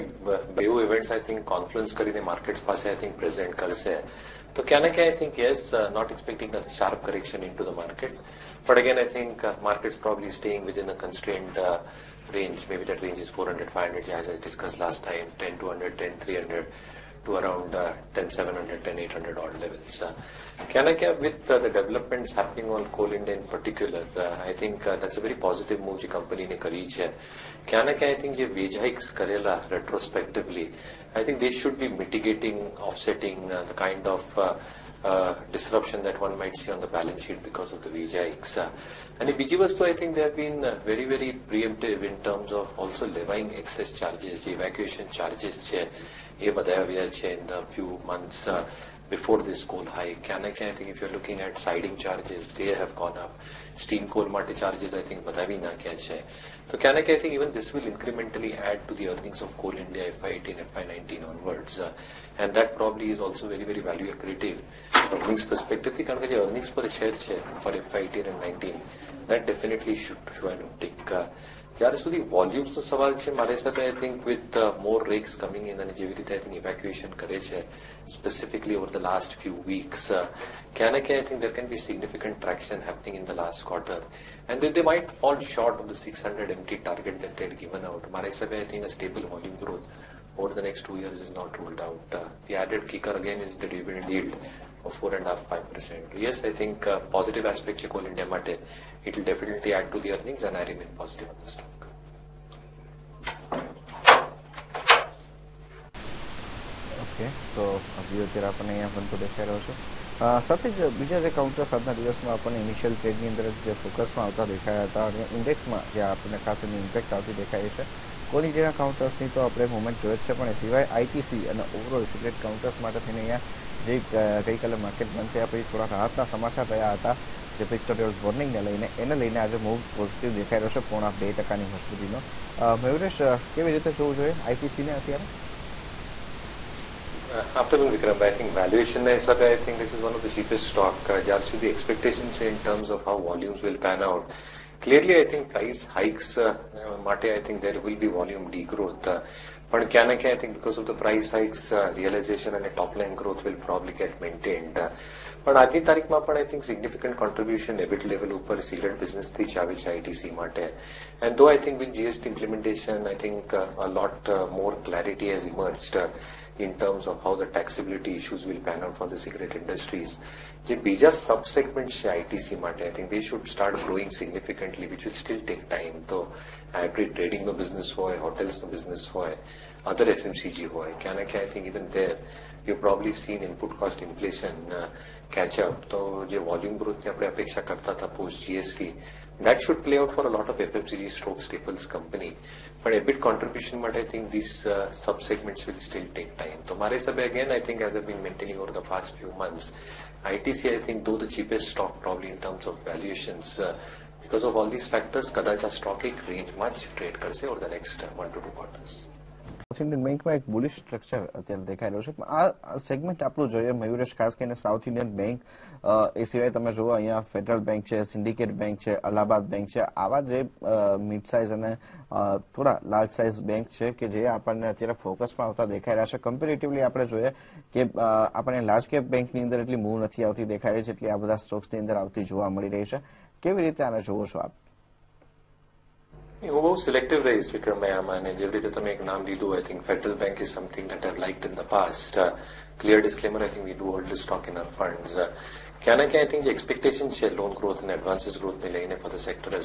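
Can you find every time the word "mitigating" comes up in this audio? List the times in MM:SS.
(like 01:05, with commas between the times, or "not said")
00:31.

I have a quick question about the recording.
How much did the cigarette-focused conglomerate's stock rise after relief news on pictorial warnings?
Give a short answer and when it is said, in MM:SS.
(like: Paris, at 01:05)
2%, at 02:11.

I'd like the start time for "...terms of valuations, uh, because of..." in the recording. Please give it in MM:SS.
03:22.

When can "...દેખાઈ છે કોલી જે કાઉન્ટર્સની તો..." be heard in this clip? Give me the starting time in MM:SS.
01:57.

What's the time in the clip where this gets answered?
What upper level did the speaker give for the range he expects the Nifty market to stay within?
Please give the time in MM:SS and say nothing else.
00:18.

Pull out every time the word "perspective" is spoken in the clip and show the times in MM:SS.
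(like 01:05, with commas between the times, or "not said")
01:05.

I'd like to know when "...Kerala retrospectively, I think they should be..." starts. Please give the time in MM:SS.
00:29.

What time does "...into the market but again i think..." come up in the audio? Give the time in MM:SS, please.
00:07.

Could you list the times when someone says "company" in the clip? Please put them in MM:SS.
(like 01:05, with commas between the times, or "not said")
00:26, 03:11.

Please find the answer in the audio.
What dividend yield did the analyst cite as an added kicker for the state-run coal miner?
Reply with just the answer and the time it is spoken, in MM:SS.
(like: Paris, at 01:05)
4.5-5%, at 01:34.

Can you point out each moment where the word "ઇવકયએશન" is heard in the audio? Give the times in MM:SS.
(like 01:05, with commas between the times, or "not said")
01:16.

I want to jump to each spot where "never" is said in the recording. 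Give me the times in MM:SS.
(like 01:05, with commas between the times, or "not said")
not said.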